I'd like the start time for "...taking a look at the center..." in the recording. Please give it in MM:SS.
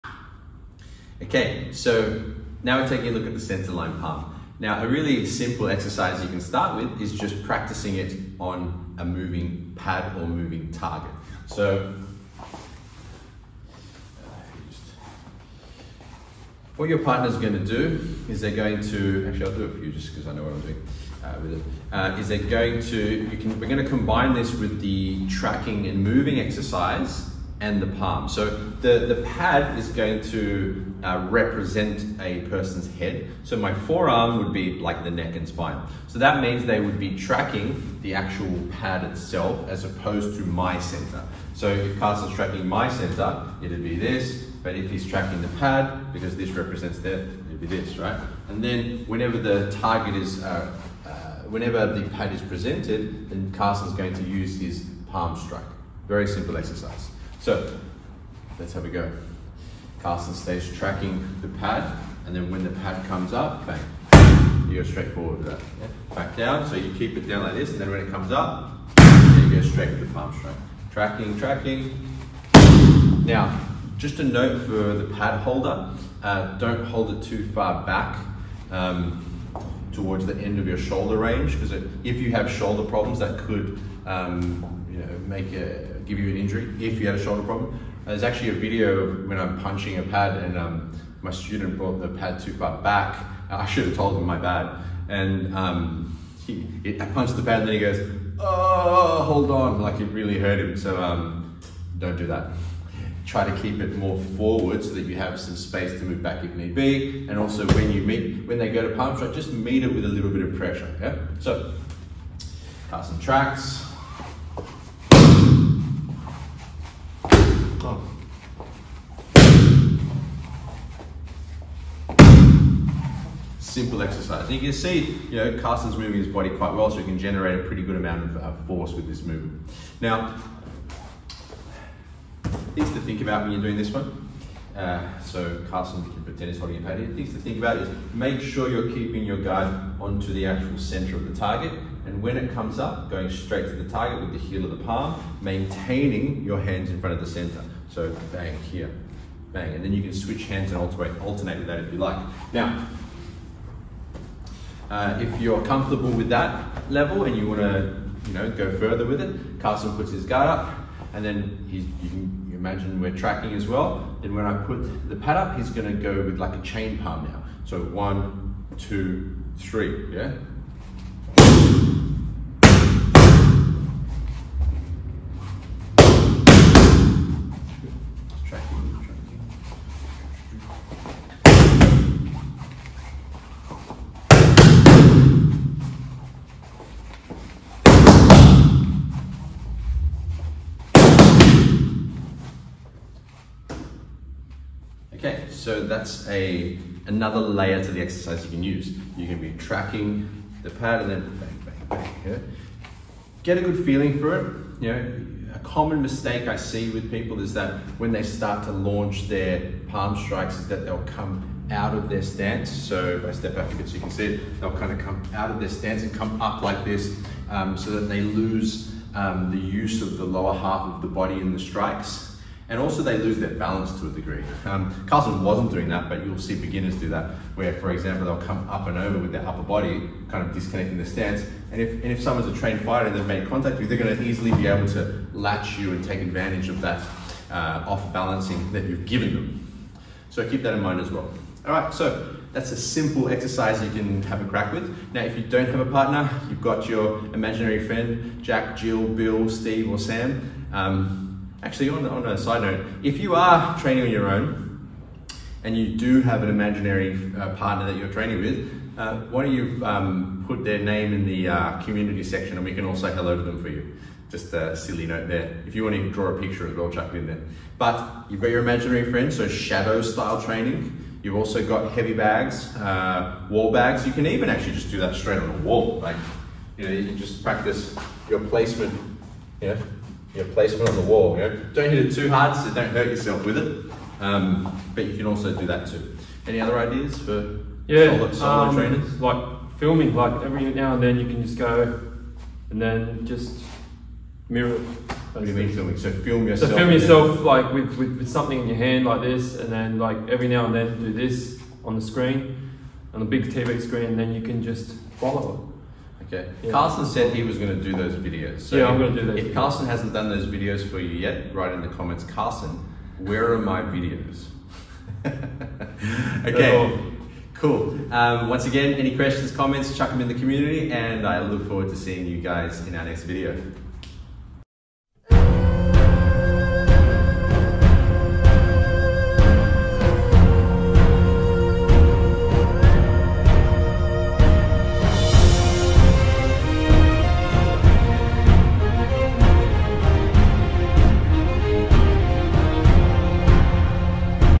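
00:02.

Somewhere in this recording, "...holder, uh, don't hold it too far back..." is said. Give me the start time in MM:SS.
01:15.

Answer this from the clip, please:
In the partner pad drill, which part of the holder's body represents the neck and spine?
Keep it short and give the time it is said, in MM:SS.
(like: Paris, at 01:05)
forearm, at 00:33.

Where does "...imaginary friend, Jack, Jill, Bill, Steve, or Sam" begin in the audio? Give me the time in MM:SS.
04:07.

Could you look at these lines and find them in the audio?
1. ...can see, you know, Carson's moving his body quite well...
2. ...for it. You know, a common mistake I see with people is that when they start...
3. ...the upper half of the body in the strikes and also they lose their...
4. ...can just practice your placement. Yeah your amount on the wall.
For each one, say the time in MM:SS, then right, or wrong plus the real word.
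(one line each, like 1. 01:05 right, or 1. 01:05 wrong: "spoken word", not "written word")
1. 02:04 right
2. 03:24 right
3. 03:40 wrong: "lower", not "upper"
4. 04:37 wrong: "placement", not "amount".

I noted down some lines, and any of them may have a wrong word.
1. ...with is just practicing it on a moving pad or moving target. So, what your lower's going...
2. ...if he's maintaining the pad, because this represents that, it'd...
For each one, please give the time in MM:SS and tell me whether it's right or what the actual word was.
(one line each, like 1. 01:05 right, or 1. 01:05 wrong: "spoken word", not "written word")
1. 00:06 wrong: "partner", not "lower"
2. 00:44 wrong: "tracking", not "maintaining".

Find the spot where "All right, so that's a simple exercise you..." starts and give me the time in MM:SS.
04:01.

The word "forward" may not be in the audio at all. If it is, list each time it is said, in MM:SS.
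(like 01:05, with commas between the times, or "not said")
01:05, 01:44, 05:21.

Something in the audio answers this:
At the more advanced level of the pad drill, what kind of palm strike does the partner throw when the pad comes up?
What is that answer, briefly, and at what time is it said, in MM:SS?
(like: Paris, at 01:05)
chain palm, at 02:46.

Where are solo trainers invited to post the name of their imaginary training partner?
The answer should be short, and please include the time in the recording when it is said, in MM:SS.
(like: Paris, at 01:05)
community section, at 04:21.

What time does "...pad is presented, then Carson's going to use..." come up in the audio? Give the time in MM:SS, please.
00:52.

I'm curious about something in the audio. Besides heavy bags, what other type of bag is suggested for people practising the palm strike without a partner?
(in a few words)
wall bags.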